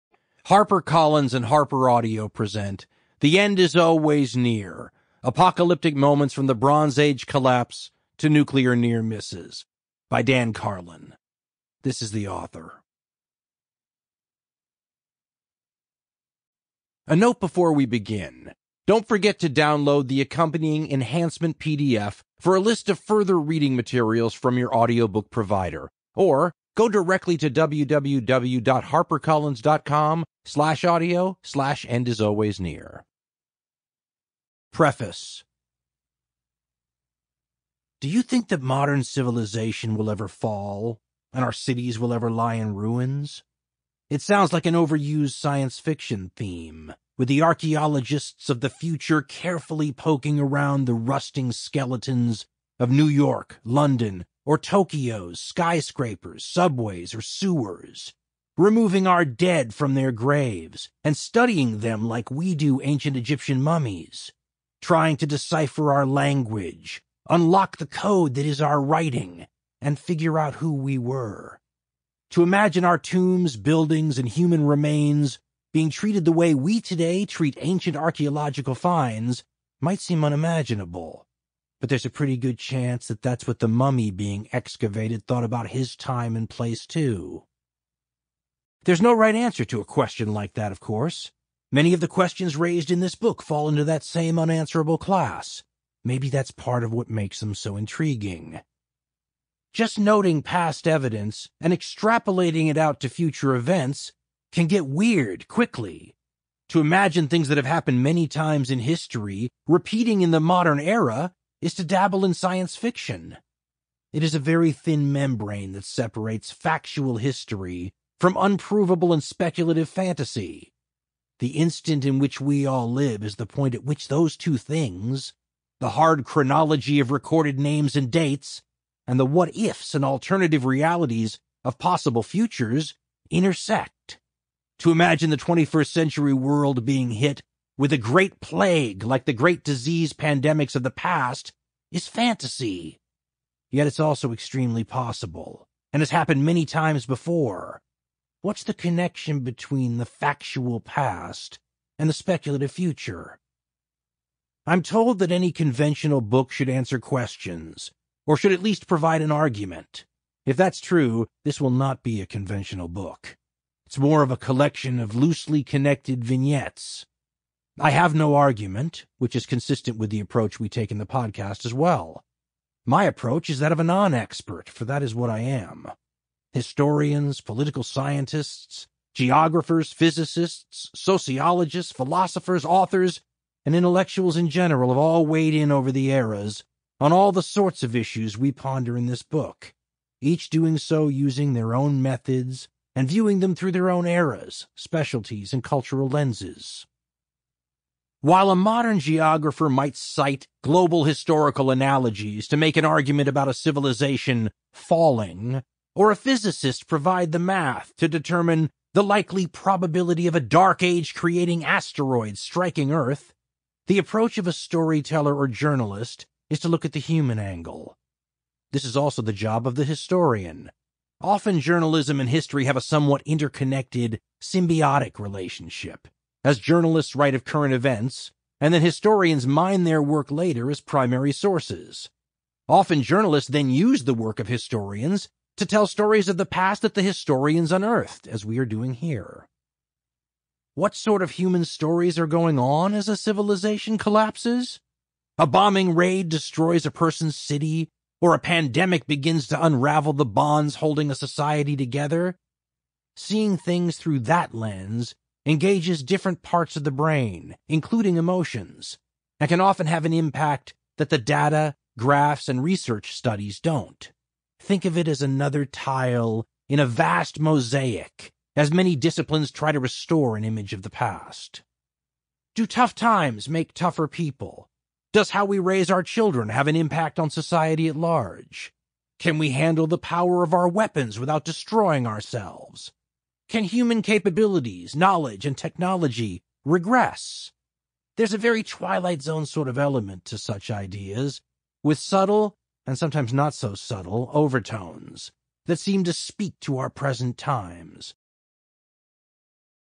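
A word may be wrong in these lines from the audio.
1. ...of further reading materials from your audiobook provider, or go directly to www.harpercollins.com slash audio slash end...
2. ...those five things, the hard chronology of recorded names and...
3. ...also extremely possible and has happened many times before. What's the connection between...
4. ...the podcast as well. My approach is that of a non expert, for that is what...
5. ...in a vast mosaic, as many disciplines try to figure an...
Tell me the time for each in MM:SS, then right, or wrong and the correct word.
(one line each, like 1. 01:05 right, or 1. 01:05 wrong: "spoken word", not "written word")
1. 00:22 right
2. 02:04 wrong: "two", not "five"
3. 02:23 right
4. 02:50 right
5. 04:26 wrong: "restore", not "figure".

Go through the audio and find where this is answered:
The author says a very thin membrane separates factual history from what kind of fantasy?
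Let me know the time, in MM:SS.
01:58.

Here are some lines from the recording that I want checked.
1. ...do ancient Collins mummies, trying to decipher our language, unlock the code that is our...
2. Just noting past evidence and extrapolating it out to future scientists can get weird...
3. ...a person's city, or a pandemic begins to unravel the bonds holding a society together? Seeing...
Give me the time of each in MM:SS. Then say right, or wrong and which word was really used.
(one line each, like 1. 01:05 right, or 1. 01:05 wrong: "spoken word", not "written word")
1. 01:02 wrong: "Egyptian", not "Collins"
2. 01:39 wrong: "events", not "scientists"
3. 04:06 right.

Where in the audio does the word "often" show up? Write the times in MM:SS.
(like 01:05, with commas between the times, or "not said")
03:41, 03:52, 04:19.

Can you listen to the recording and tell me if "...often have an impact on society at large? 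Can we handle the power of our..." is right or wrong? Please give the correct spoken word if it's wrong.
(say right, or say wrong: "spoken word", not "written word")
wrong: "children", not "often".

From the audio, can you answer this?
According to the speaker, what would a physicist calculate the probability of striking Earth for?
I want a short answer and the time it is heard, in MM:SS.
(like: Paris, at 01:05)
asteroids, at 03:31.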